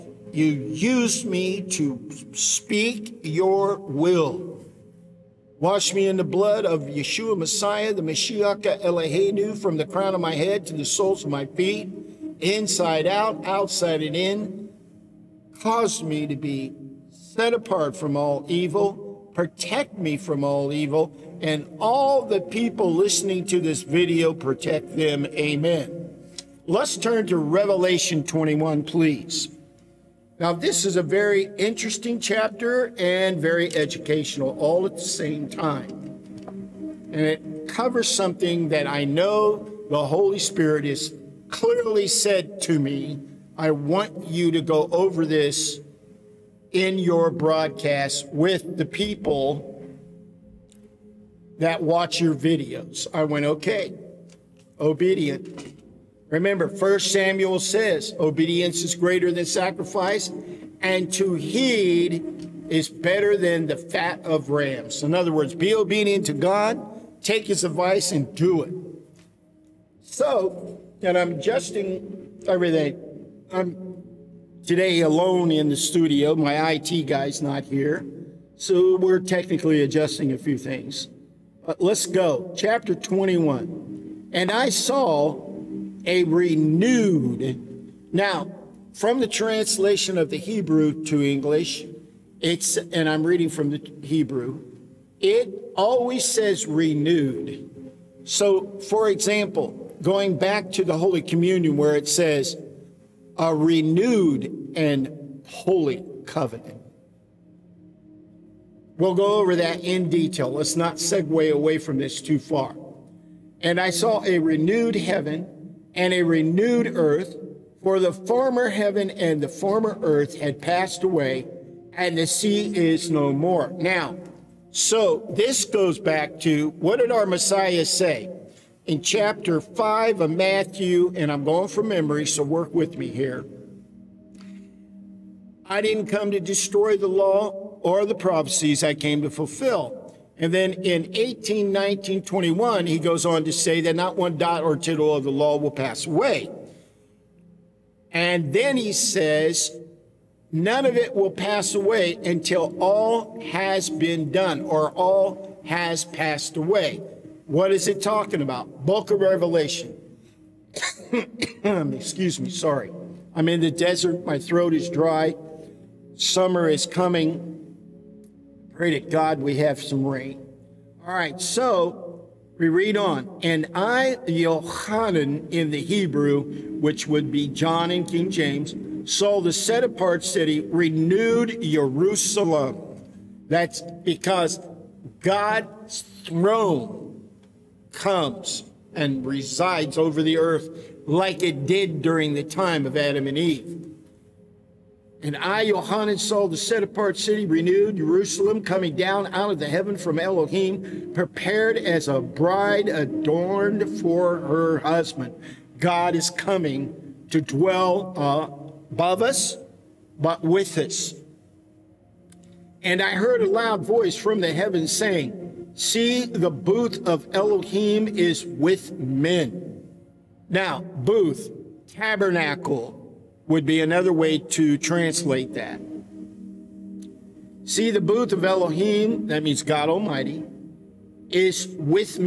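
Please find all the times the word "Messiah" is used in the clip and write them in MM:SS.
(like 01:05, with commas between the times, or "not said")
00:07, 02:07.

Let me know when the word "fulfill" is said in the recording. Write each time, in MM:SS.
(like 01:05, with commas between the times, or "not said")
02:19.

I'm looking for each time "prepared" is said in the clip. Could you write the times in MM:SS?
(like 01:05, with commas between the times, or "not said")
03:21.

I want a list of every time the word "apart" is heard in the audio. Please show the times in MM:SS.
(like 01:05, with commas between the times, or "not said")
00:17, 02:59, 03:16.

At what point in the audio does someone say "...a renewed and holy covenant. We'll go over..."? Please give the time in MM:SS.
01:43.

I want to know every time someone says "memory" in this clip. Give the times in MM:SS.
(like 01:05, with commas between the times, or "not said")
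02:11.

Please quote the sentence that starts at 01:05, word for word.
In other words, be obedient to God, take his advice, and do it.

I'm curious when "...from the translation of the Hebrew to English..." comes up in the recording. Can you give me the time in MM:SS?
01:28.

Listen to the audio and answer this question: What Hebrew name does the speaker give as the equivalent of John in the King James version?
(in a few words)
Yohanan.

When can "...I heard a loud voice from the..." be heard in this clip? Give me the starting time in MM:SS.
03:33.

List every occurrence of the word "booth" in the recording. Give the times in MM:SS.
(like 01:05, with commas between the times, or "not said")
03:36, 03:40, 03:48.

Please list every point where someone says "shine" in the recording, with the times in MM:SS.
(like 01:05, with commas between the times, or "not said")
not said.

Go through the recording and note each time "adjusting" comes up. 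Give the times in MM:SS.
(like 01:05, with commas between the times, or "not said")
01:11, 01:19.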